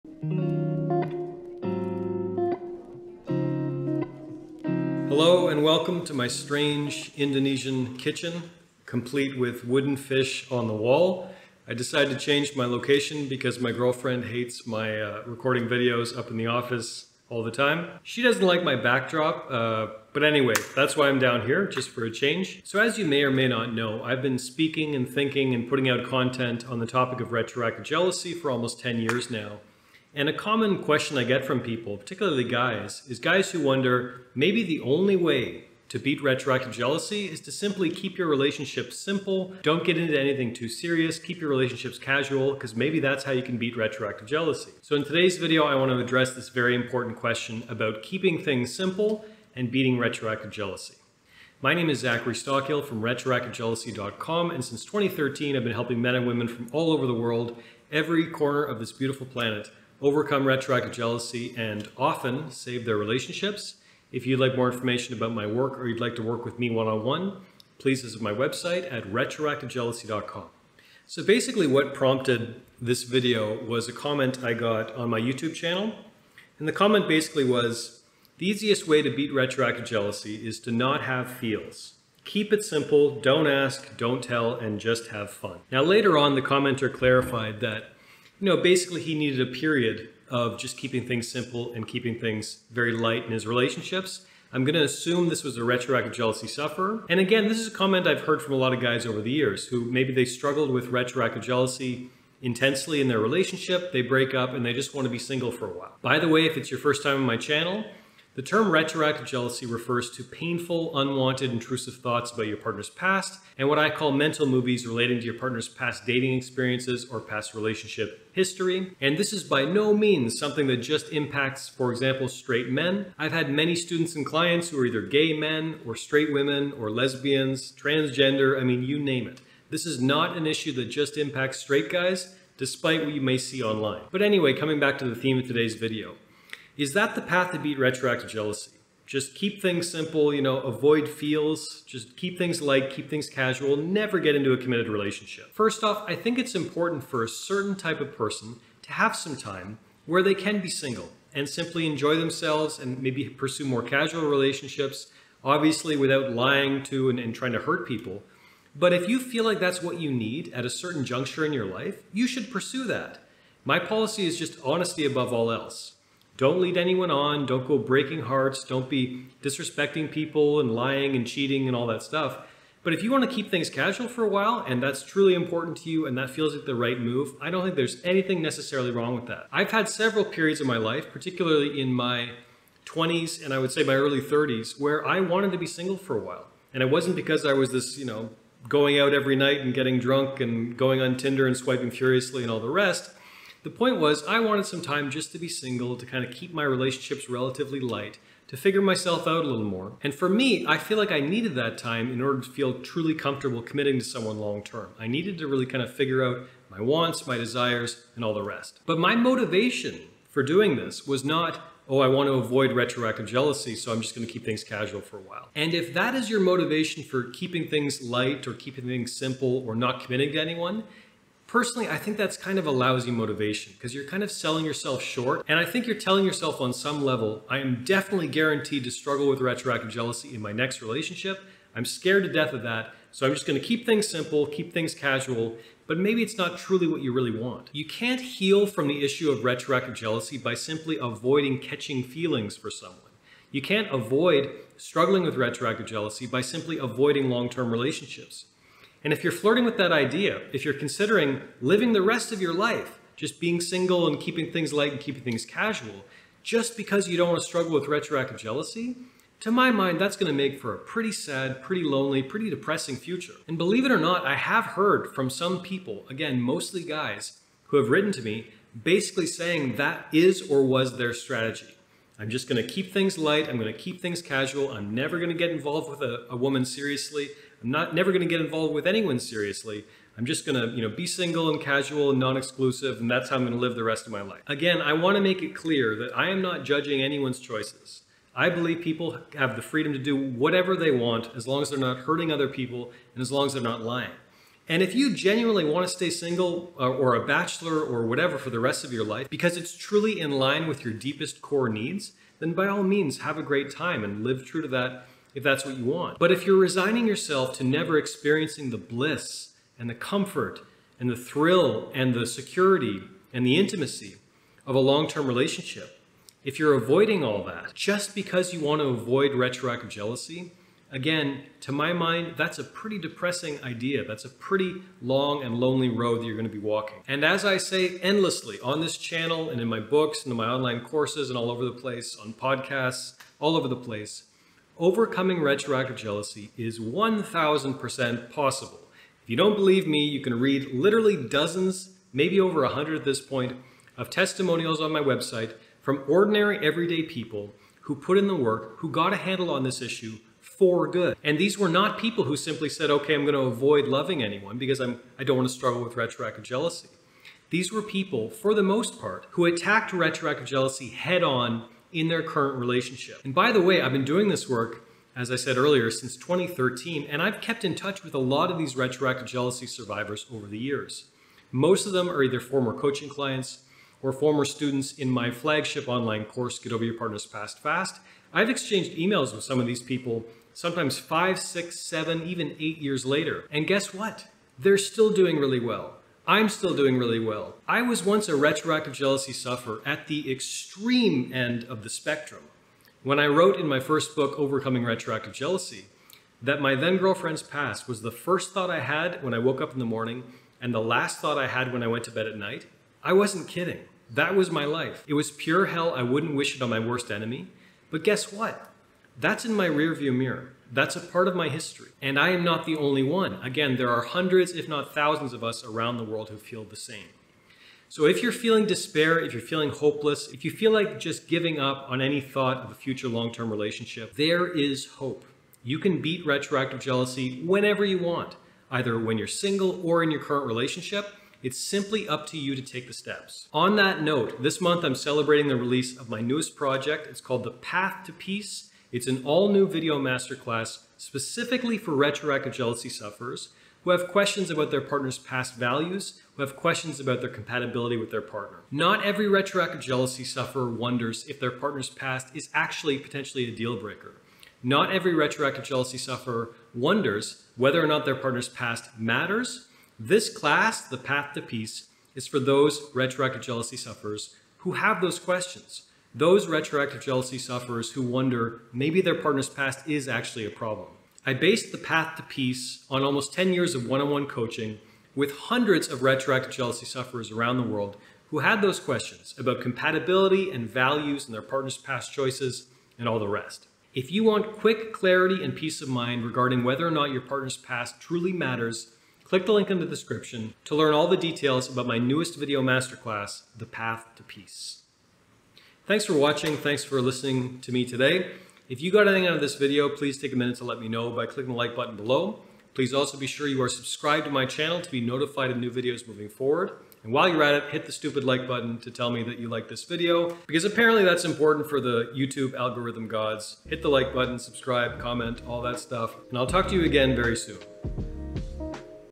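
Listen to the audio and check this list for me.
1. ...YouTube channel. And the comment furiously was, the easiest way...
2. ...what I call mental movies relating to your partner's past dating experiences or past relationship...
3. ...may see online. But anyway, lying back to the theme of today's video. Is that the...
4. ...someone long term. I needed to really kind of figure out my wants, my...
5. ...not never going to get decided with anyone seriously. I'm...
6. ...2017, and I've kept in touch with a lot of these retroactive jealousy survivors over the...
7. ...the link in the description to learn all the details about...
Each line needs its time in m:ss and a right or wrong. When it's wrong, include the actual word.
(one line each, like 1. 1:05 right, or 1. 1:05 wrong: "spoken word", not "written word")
1. 1:15 wrong: "basically", not "furiously"
2. 1:53 right
3. 2:13 wrong: "coming", not "lying"
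4. 3:24 right
5. 4:37 wrong: "involved", not "decided"
6. 6:06 wrong: "2013", not "2017"
7. 8:09 right.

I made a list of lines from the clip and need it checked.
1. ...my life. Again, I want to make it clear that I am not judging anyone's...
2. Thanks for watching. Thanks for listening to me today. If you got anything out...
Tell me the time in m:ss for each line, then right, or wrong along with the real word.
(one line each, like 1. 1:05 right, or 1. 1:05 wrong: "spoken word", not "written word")
1. 4:44 right
2. 8:15 right.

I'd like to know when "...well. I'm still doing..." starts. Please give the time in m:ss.
6:25.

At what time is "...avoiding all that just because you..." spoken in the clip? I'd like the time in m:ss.
5:16.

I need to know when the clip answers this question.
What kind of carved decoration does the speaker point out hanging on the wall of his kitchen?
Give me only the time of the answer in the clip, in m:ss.
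0:09.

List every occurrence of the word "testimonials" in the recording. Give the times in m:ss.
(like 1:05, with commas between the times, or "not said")
5:44.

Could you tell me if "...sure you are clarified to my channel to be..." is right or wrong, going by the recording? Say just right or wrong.
wrong.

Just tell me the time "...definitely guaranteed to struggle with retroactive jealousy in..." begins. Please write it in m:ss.
3:47.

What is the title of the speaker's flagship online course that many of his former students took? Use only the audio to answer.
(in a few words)
Get Over Your Partner's Past Fast.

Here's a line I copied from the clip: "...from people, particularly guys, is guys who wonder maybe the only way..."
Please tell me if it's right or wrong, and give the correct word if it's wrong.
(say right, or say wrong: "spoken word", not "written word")
right.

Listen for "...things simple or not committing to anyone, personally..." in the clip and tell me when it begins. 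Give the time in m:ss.
3:38.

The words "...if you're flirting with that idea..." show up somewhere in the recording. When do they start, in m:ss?
4:09.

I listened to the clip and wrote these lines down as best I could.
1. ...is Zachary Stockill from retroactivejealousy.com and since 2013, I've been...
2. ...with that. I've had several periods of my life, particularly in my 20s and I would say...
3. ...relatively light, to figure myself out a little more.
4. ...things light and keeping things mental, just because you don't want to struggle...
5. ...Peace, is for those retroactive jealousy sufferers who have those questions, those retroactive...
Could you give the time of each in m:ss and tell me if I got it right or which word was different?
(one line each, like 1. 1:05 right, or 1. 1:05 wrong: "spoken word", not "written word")
1. 0:51 right
2. 2:59 right
3. 3:17 right
4. 4:14 wrong: "casual", not "mental"
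5. 7:41 right.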